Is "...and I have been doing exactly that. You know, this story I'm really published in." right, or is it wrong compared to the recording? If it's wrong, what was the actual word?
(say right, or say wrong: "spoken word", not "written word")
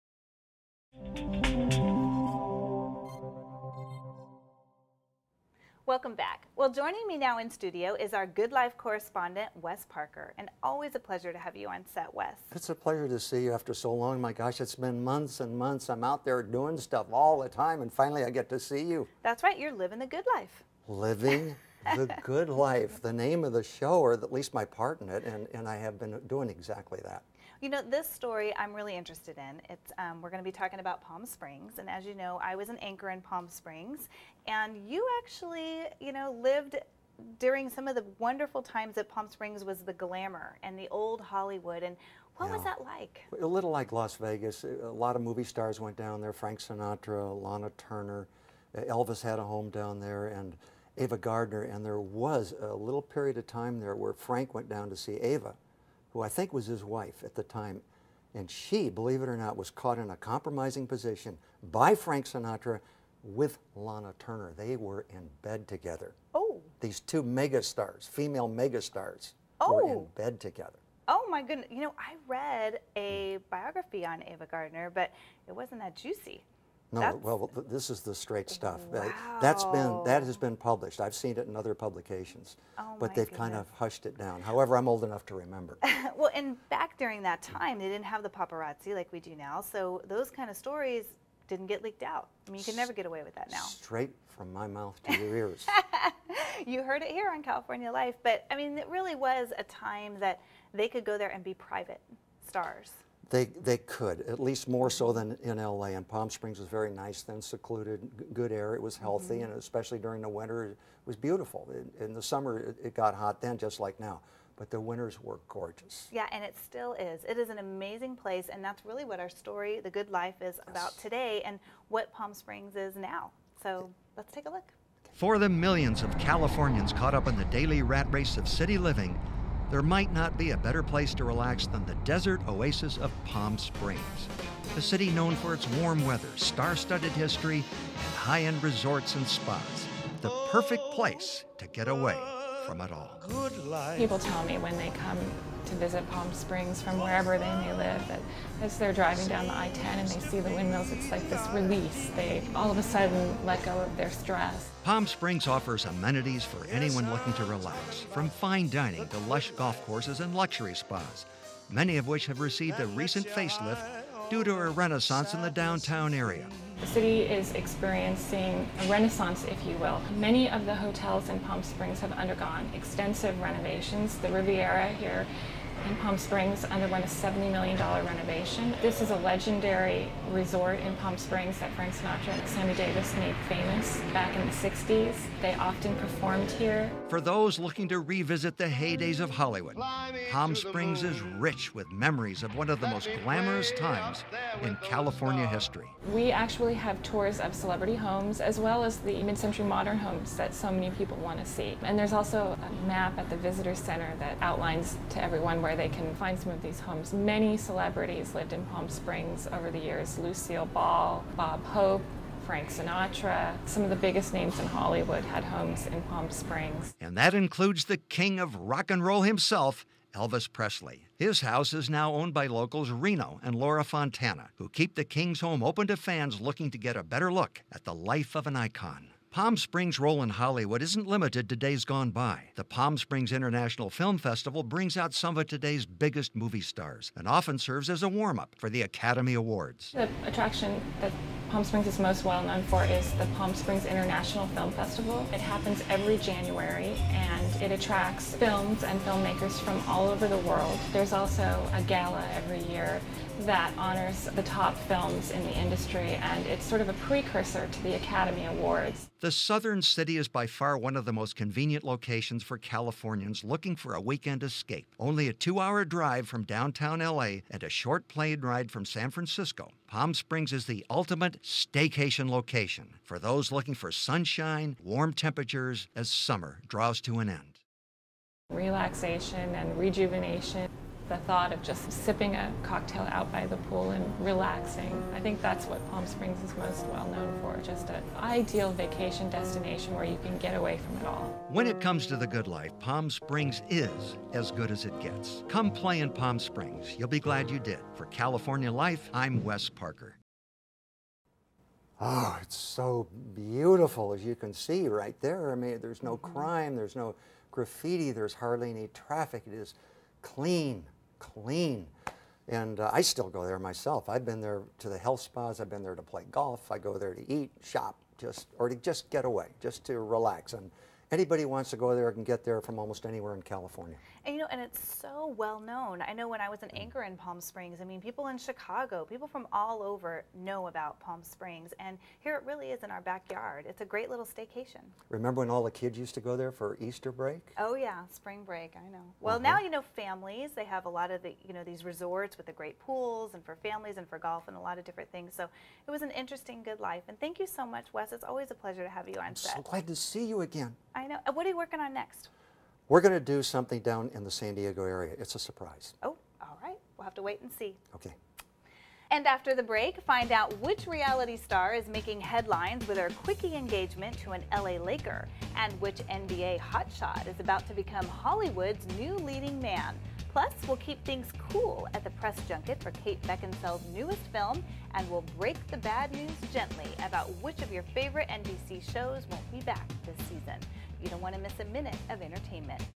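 wrong: "interested", not "published".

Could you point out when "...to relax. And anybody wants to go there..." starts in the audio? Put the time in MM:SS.
05:19.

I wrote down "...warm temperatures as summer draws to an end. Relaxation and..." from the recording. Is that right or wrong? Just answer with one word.
right.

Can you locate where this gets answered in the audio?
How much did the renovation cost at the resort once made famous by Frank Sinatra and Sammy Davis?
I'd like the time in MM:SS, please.
02:57.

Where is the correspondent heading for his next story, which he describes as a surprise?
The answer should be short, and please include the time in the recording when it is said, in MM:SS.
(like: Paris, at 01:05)
San Diego area, at 05:54.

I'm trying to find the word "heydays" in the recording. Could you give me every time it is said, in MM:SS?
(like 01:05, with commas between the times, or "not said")
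03:08.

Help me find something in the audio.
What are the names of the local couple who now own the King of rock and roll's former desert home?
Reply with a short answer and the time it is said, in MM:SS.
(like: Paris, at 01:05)
Reno and Laura Fontana, at 03:42.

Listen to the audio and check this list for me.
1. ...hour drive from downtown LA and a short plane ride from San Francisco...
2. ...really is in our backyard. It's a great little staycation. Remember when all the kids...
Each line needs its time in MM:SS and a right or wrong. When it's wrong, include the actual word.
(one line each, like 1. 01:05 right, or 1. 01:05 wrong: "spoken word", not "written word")
1. 04:25 right
2. 05:32 right.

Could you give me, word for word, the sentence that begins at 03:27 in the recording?
Many celebrities lived in Palm Springs over the years Lucille Ball, Bob Hope, Frank Sinatra.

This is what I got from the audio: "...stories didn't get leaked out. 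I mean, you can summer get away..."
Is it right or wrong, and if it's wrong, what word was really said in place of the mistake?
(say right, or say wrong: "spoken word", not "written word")
wrong: "never", not "summer".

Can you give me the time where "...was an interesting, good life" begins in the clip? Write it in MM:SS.
05:45.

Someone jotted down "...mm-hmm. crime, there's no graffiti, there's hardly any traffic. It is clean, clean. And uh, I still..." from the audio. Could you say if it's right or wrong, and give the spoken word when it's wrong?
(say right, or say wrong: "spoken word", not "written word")
right.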